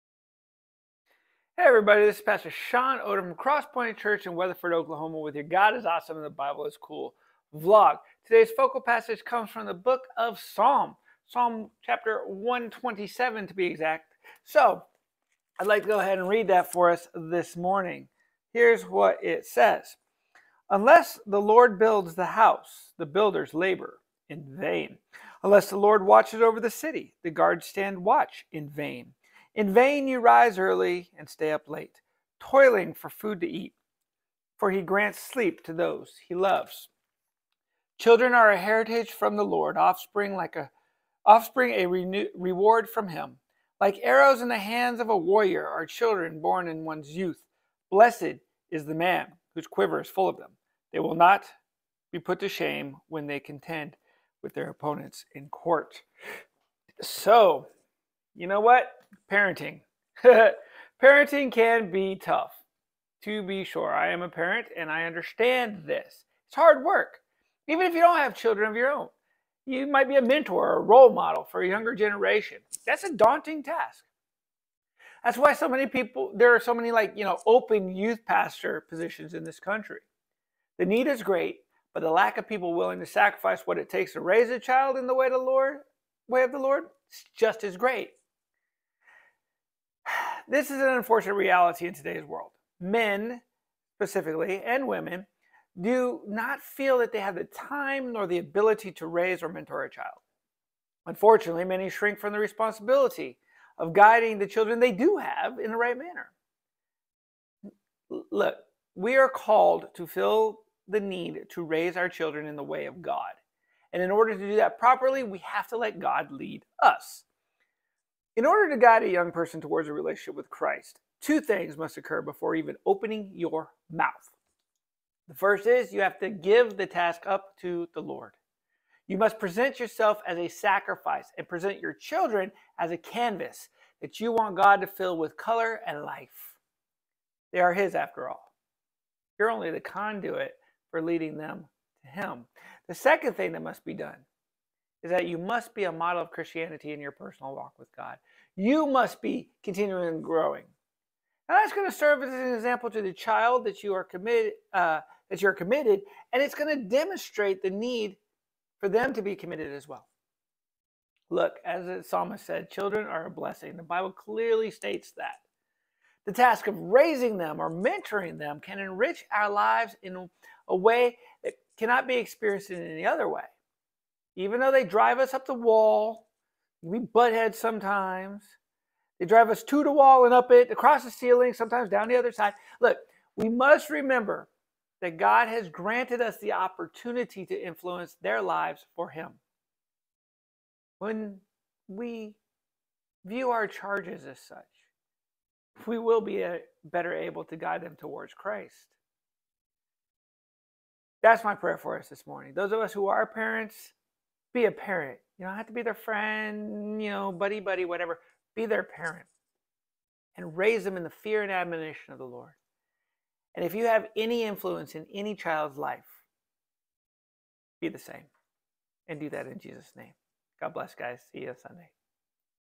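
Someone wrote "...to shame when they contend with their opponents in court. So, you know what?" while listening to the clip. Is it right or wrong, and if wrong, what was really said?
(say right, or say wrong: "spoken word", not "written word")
right.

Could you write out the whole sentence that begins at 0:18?
Here's what it says Unless the Lord builds the house, the builders labor in vain.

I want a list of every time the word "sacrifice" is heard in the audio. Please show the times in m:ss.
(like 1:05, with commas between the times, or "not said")
1:23, 2:10.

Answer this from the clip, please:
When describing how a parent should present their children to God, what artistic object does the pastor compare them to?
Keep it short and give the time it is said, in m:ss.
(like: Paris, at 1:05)
A canvas, at 2:12.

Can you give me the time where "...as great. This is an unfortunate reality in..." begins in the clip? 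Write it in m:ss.
1:27.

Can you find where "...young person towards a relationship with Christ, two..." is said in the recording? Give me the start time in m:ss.
1:59.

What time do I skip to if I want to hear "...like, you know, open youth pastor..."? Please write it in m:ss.
1:16.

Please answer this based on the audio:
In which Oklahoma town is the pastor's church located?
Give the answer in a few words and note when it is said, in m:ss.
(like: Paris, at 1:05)
Weatherford, at 0:04.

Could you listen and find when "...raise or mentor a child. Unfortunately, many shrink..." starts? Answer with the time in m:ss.
1:39.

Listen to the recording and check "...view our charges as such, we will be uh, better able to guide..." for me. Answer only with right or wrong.
right.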